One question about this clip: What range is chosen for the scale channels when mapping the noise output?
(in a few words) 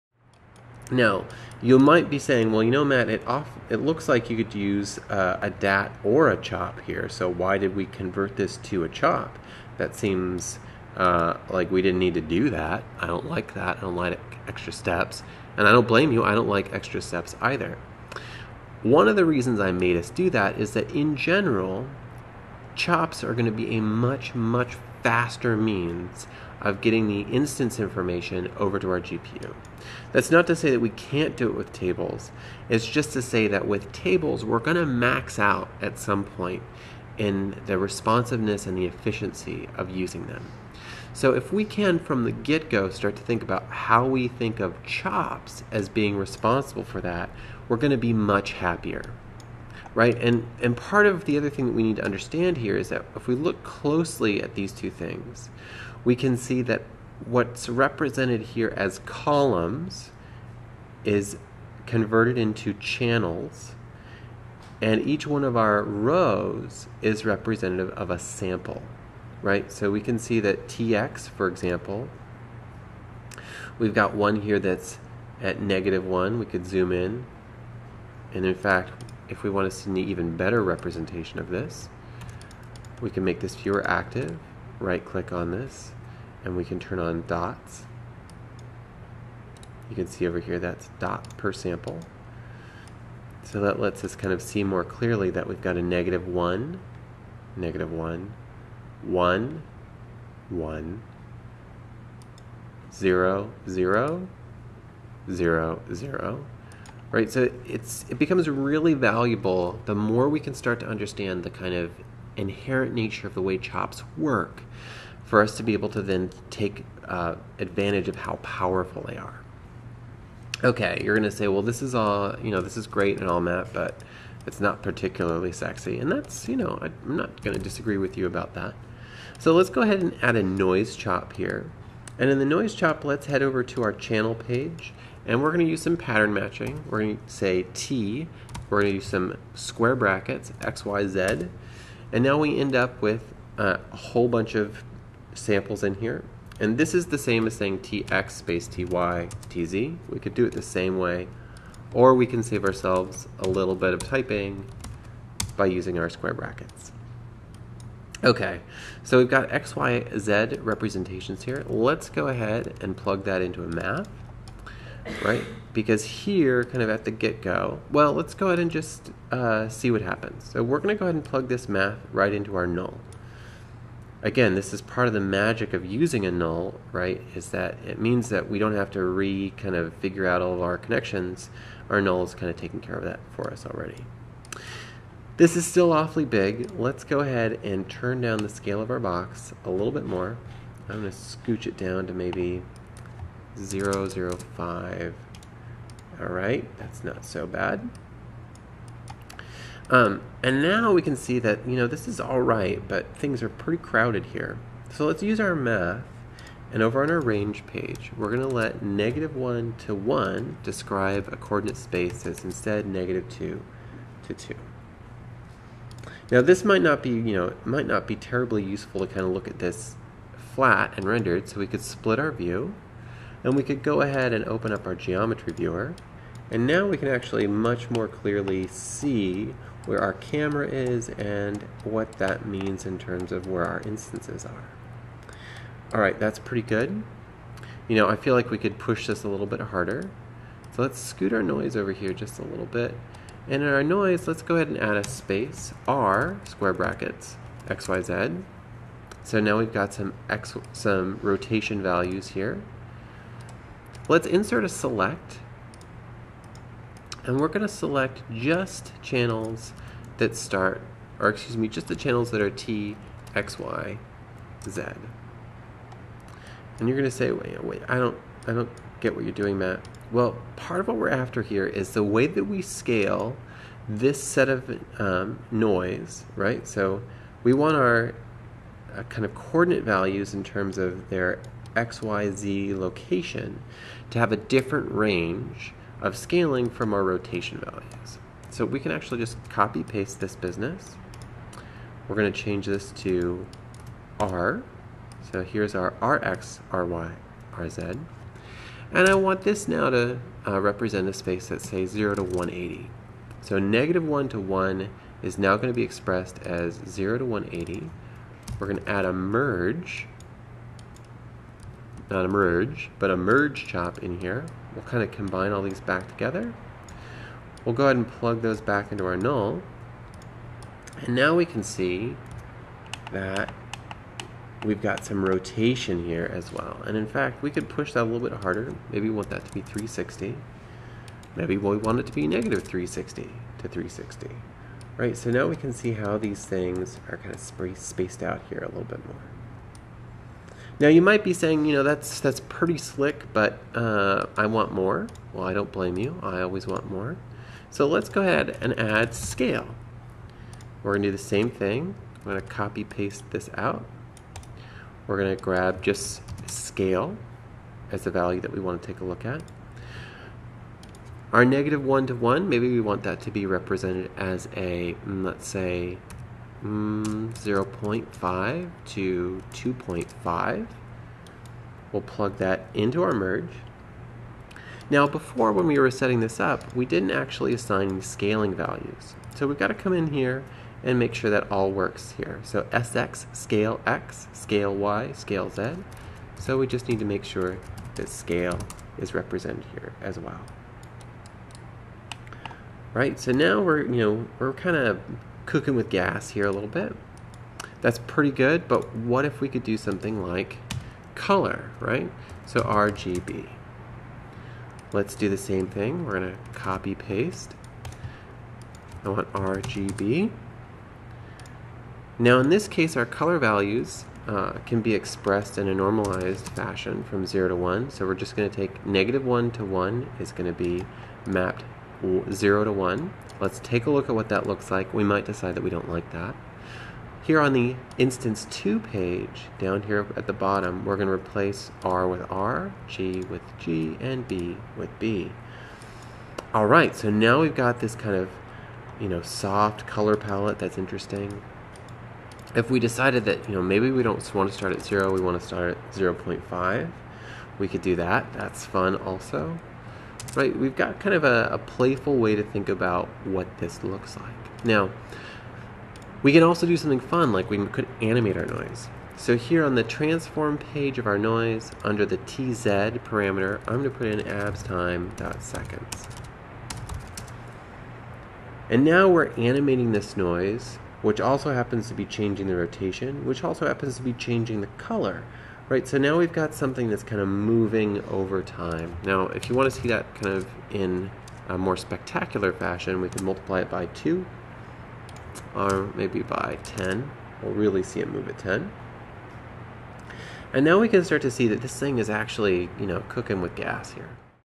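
0.5 to 2.5.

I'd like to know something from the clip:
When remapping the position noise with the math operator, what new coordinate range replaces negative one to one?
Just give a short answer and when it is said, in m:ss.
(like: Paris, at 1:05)
-2 to 2, at 3:32.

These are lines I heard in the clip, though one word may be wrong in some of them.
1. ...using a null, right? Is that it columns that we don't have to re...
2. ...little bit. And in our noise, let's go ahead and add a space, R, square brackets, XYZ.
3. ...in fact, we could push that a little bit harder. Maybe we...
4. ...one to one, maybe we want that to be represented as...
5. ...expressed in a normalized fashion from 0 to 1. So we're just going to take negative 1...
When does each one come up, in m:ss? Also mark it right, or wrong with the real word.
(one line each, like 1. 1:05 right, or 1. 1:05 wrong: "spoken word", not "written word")
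1. 2:55 wrong: "means", not "columns"
2. 4:02 right
3. 5:26 right
4. 6:01 right
5. 6:54 right.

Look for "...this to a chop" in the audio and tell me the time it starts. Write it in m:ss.
0:08.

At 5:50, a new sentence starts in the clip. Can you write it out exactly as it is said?
We're gonna do the same thing.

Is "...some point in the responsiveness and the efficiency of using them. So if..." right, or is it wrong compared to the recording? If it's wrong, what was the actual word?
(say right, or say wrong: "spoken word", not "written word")
right.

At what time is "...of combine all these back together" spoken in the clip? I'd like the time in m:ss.
5:15.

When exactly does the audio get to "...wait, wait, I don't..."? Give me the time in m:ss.
4:27.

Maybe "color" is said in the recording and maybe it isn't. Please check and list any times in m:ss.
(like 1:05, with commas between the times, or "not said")
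6:41, 6:53, 7:19, 7:54.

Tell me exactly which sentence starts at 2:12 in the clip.
And in the noise chop, let's head over to our channel page and we're going to use some pattern matching.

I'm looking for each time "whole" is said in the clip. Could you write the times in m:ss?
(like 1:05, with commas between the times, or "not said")
2:23.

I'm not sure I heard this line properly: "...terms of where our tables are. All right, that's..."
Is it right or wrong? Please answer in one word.
wrong.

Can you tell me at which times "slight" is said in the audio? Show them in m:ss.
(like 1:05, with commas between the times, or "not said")
not said.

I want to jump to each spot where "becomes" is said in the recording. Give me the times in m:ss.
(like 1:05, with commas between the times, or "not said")
1:48.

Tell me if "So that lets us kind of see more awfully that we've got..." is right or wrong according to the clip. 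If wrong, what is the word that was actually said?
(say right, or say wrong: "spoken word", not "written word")
wrong: "clearly", not "awfully".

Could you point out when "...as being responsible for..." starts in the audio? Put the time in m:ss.
0:45.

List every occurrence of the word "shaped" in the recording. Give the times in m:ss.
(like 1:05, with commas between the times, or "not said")
not said.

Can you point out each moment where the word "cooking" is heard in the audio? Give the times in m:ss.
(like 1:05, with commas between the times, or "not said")
6:35, 8:13.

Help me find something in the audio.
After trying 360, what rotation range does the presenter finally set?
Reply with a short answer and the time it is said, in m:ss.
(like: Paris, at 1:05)
-360 to 360, at 5:32.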